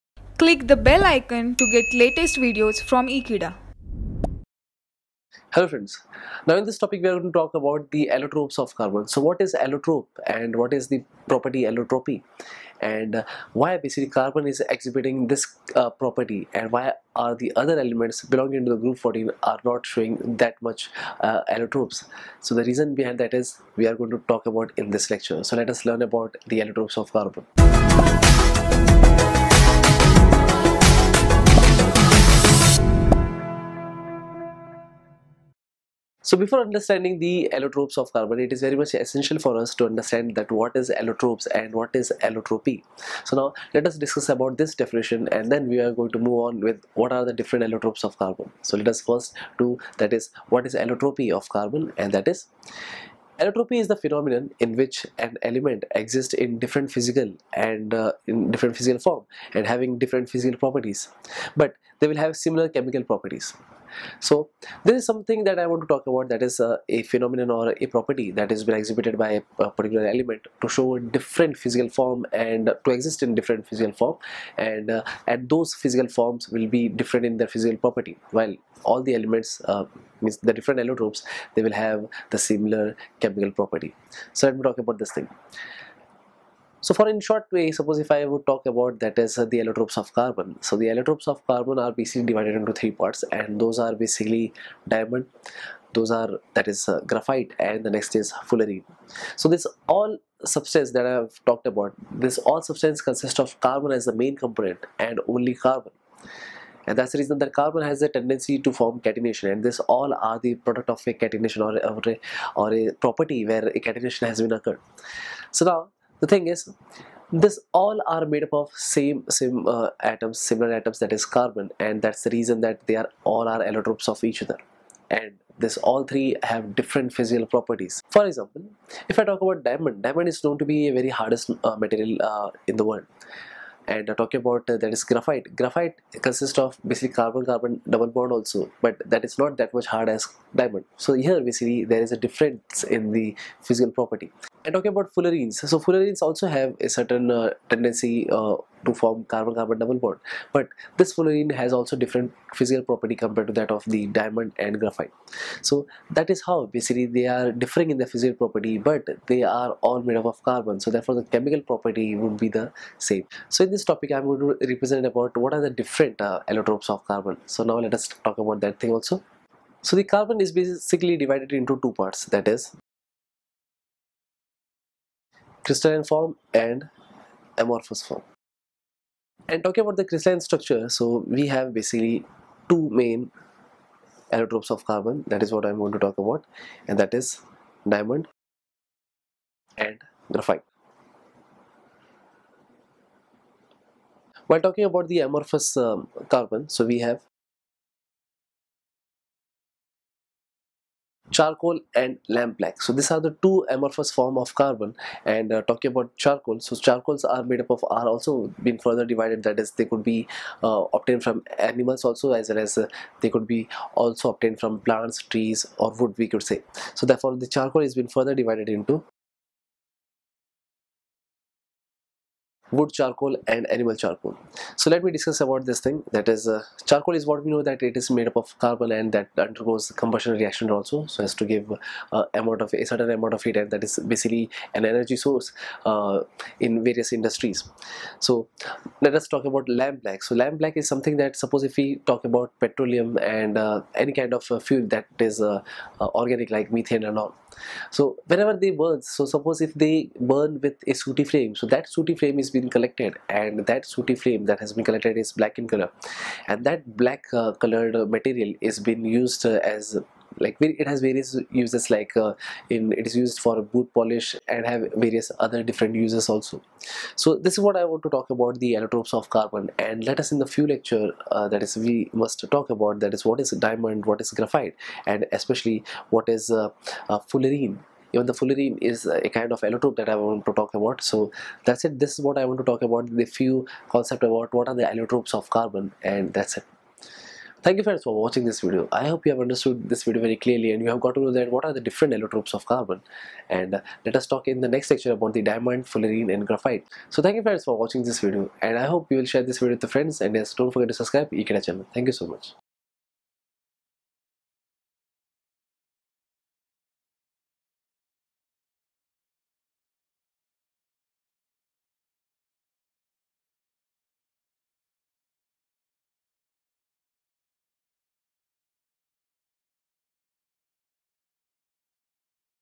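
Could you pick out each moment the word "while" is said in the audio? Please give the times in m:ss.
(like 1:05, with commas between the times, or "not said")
1:18, 3:14.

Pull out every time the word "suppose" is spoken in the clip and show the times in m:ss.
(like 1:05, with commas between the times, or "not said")
1:27, 4:01, 4:09.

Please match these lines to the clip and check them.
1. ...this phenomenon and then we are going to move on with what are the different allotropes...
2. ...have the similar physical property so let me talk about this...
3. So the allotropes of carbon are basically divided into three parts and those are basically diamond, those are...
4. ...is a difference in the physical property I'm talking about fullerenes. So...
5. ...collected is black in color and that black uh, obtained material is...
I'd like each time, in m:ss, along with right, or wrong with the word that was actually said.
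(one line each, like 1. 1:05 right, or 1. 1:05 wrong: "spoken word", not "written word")
1. 0:44 wrong: "definition", not "phenomenon"
2. 1:21 wrong: "chemical", not "physical"
3. 1:30 right
4. 2:22 right
5. 4:14 wrong: "colored", not "obtained".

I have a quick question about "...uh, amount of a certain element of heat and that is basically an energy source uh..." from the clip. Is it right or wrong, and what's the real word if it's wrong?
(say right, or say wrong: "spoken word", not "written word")
wrong: "amount", not "element".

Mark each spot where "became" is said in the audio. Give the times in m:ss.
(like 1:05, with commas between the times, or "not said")
not said.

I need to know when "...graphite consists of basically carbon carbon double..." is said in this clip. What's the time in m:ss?
2:15.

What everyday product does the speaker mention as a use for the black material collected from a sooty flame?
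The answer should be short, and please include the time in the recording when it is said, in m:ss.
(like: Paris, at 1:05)
Boot polish, at 4:23.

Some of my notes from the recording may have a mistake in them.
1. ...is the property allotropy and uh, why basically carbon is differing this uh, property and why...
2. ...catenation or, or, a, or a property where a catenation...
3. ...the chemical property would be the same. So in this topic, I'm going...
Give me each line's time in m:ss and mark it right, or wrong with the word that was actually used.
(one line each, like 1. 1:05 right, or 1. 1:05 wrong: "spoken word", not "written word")
1. 0:10 wrong: "exhibiting", not "differing"
2. 1:51 right
3. 2:41 right.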